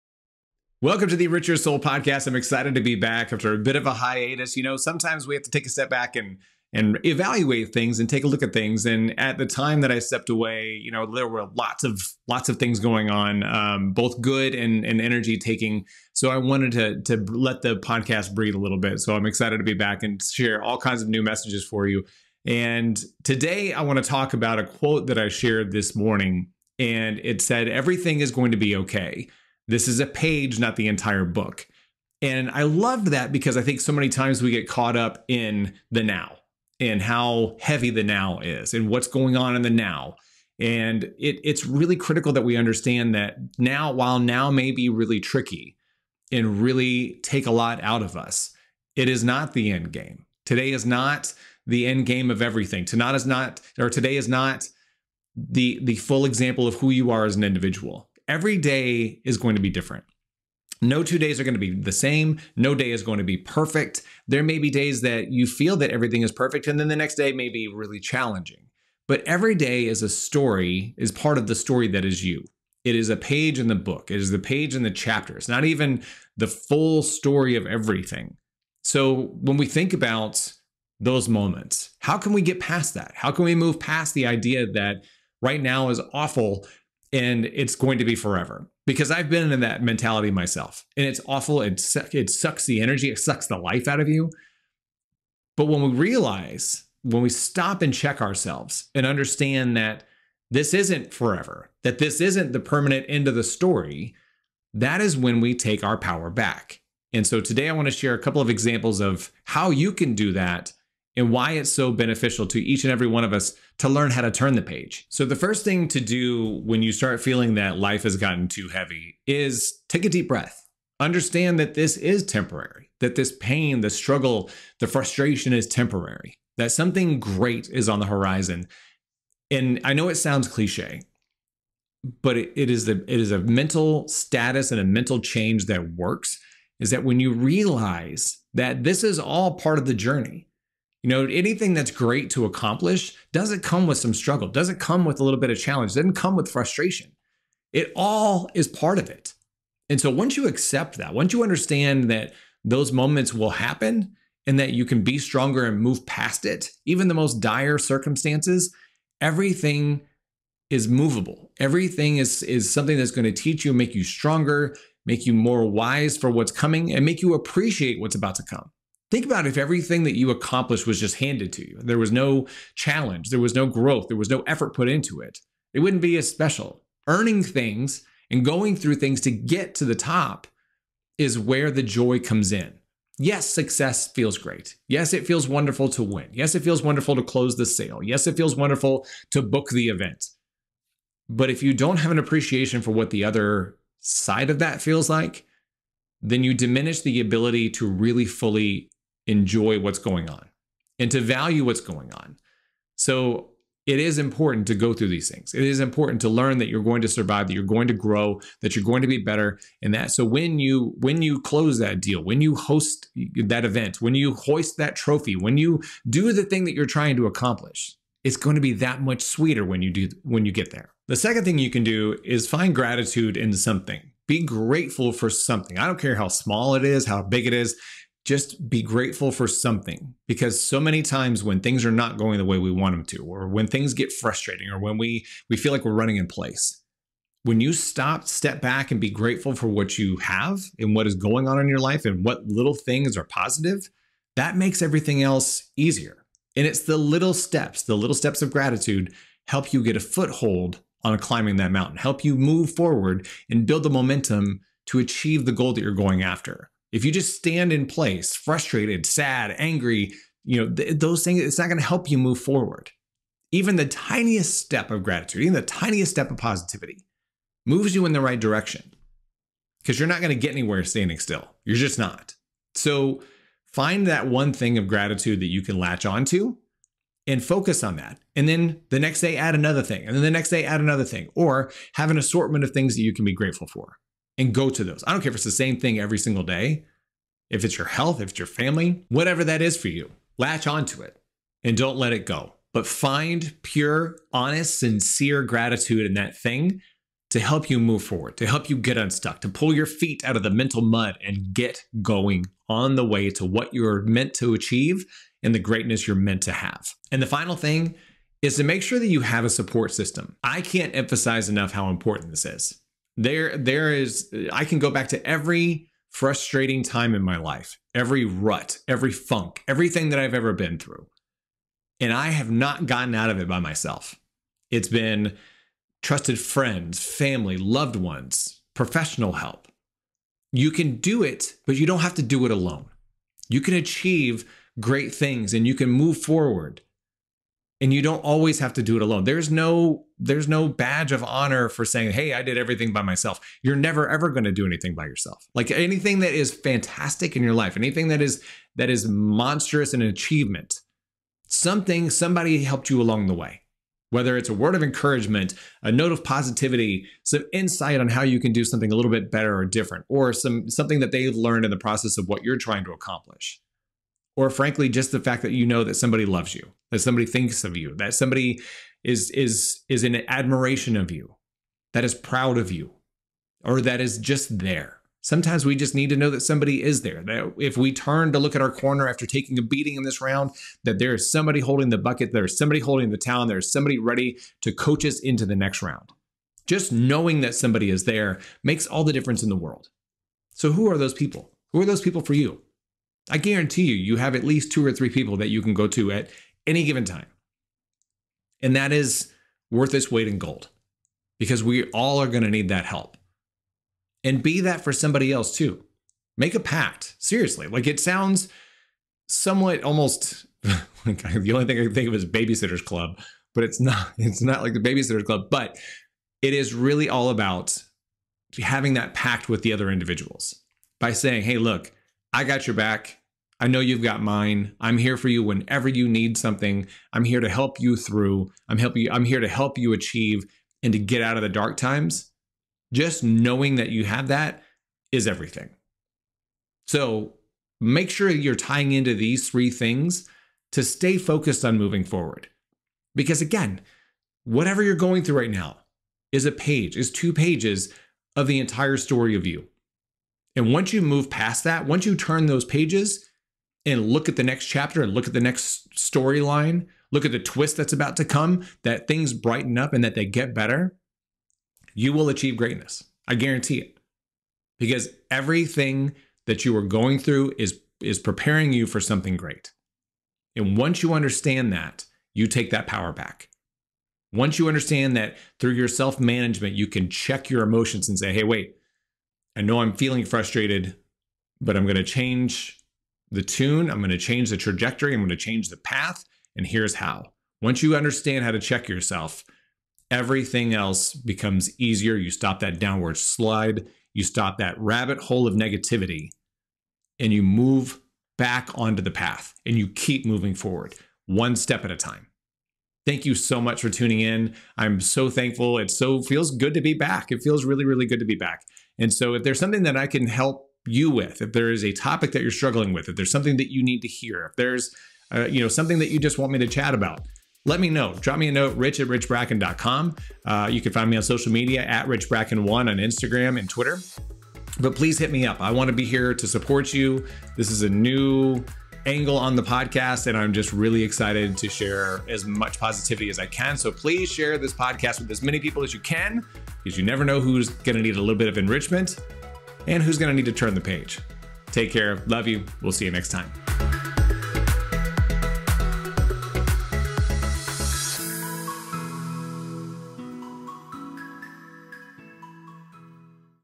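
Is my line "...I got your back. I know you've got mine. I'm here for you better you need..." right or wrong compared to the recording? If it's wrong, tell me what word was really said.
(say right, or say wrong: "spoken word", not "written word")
wrong: "whenever", not "better".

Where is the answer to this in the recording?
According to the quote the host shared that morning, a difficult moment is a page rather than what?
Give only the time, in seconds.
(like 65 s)
30 s.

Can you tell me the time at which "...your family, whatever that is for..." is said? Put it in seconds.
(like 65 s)
288 s.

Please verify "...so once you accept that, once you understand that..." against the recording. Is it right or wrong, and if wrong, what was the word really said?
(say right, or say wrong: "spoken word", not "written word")
right.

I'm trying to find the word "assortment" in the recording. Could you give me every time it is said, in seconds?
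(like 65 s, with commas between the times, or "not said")
282 s.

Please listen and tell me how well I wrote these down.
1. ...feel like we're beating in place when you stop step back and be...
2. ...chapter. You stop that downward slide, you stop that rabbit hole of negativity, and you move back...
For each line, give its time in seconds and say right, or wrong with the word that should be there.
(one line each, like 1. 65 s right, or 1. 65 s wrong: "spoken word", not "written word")
1. 235 s wrong: "running", not "beating"
2. 491 s wrong: "easier", not "chapter".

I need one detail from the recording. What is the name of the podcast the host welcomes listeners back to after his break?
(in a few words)
Richer Soul.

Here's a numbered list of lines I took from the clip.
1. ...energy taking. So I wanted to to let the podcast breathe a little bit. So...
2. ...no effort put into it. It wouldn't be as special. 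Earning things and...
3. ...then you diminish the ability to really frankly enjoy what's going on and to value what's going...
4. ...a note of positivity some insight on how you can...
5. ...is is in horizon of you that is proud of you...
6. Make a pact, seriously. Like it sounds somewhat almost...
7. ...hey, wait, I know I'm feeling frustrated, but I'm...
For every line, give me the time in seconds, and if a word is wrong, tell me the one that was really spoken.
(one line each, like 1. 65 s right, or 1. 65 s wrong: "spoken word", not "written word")
1. 14 s right
2. 174 s right
3. 196 s wrong: "fully", not "frankly"
4. 355 s right
5. 369 s wrong: "admiration", not "horizon"
6. 406 s right
7. 478 s right.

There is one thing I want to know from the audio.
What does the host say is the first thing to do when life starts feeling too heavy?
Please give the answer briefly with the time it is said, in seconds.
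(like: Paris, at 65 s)
take a deep breath, at 119 s.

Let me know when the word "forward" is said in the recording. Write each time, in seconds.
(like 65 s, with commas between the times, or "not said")
252 s, 262 s, 298 s, 336 s, 442 s, 500 s.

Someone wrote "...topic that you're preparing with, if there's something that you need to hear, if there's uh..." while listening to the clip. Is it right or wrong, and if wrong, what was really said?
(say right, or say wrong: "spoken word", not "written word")
wrong: "struggling", not "preparing".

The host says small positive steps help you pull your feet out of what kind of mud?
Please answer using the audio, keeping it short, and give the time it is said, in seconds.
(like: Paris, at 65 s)
mental mud, at 300 s.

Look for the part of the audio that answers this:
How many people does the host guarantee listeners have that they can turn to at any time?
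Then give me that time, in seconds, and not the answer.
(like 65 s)
394 s.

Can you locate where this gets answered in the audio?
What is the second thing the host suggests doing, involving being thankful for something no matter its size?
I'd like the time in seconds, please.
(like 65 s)
222 s.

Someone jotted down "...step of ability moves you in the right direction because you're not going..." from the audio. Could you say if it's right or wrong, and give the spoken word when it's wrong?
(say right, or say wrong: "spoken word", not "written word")
wrong: "positivity", not "ability".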